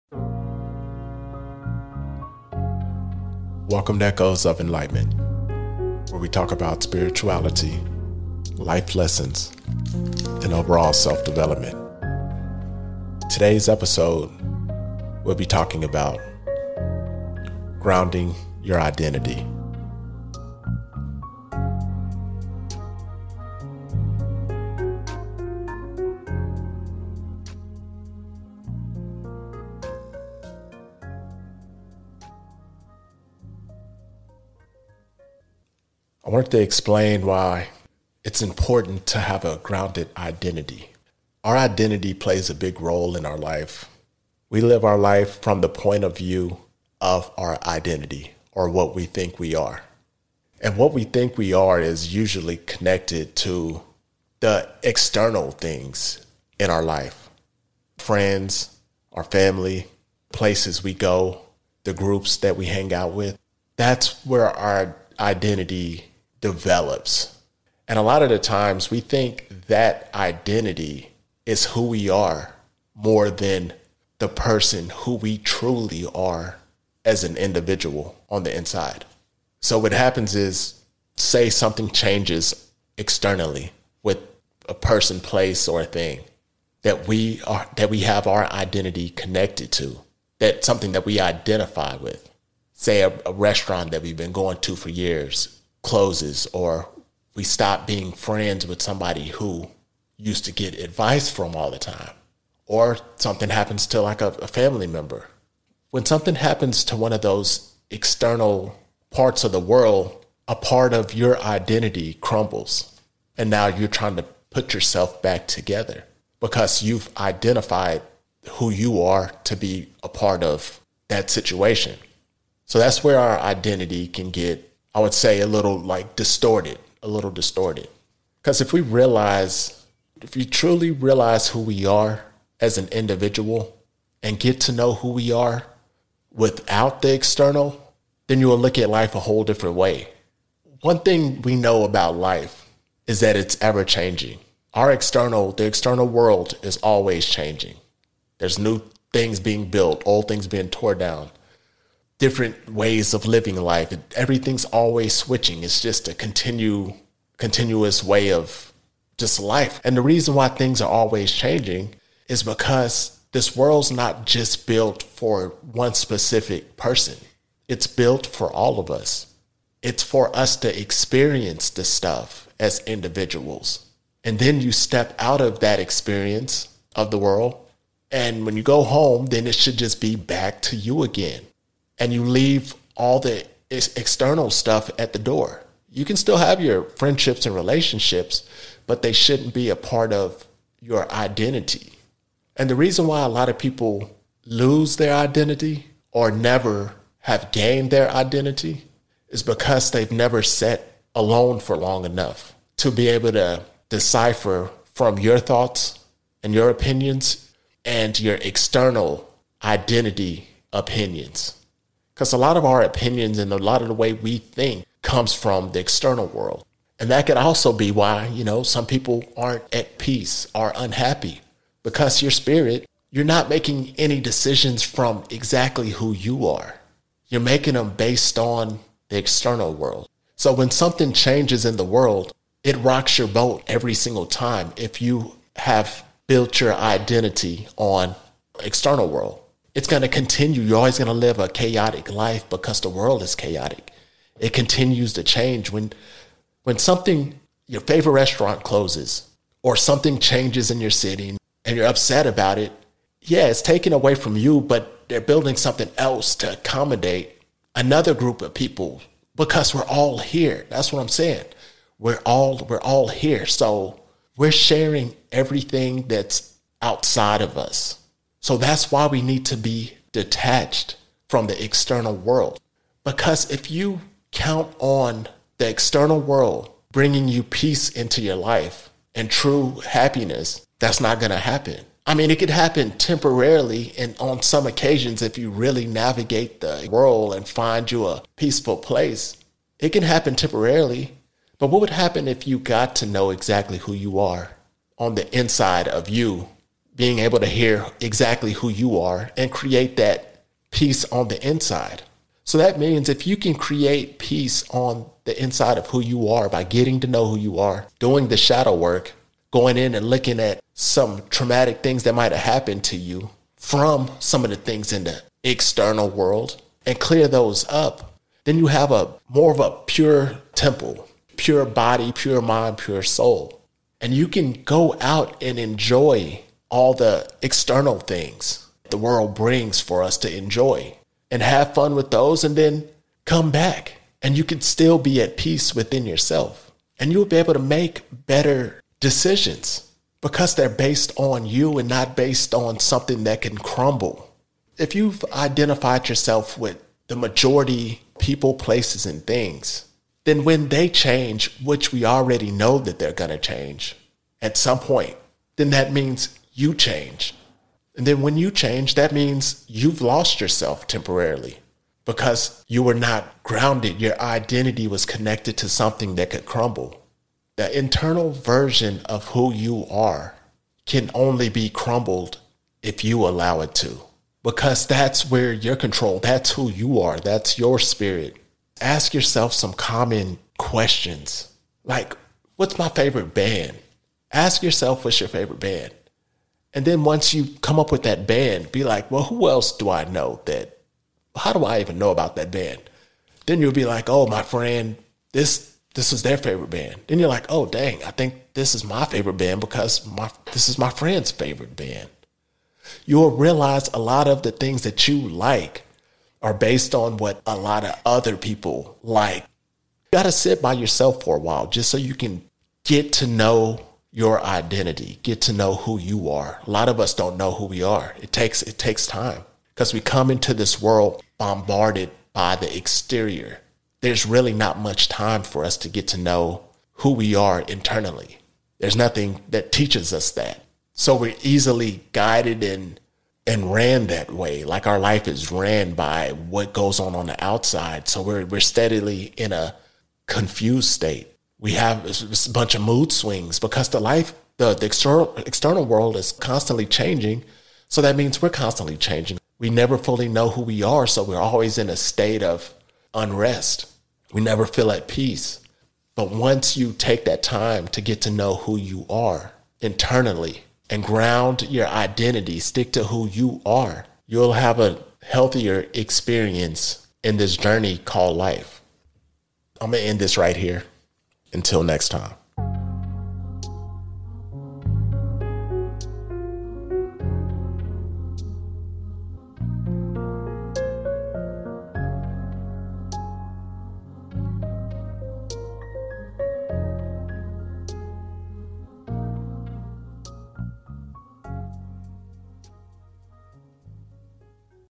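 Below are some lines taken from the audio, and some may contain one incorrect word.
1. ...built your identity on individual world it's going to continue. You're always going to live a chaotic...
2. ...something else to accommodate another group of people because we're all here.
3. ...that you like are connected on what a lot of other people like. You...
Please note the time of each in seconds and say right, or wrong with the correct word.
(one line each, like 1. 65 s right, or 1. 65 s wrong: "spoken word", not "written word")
1. 236 s wrong: "external", not "individual"
2. 255 s right
3. 404 s wrong: "based", not "connected".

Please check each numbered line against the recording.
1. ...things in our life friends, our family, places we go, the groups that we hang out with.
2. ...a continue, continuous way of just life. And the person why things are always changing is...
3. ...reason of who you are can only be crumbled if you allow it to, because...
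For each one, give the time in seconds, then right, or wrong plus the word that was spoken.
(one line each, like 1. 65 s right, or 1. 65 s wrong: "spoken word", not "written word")
1. 55 s right
2. 156 s wrong: "reason", not "person"
3. 368 s wrong: "version", not "reason".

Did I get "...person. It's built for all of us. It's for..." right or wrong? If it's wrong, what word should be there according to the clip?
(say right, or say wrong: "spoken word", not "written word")
right.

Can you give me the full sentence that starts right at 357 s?
And then when you change, that means you've lost yourself temporarily because you were not grounded.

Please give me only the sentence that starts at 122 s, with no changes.
So that's where our identity can get I would say a little like distorted, a little distorted.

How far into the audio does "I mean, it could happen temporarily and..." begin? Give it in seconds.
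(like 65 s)
282 s.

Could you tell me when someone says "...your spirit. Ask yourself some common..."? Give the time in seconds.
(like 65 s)
377 s.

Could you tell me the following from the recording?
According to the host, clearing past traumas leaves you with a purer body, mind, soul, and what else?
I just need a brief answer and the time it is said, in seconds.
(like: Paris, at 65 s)
temple, at 319 s.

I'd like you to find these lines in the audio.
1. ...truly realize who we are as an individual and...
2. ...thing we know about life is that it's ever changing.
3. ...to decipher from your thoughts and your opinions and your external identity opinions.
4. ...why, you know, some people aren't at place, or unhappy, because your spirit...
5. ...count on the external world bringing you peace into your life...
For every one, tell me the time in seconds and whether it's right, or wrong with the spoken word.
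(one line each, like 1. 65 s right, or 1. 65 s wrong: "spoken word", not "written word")
1. 130 s right
2. 140 s right
3. 203 s right
4. 217 s wrong: "peace", not "place"
5. 274 s right.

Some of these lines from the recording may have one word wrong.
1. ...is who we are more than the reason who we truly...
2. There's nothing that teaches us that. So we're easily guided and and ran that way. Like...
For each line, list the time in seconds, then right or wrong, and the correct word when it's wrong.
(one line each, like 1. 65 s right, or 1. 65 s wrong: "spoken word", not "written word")
1. 71 s wrong: "person", not "reason"
2. 428 s right.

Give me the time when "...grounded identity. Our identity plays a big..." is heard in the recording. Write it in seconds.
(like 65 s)
39 s.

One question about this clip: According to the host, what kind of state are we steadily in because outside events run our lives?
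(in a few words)
confused state.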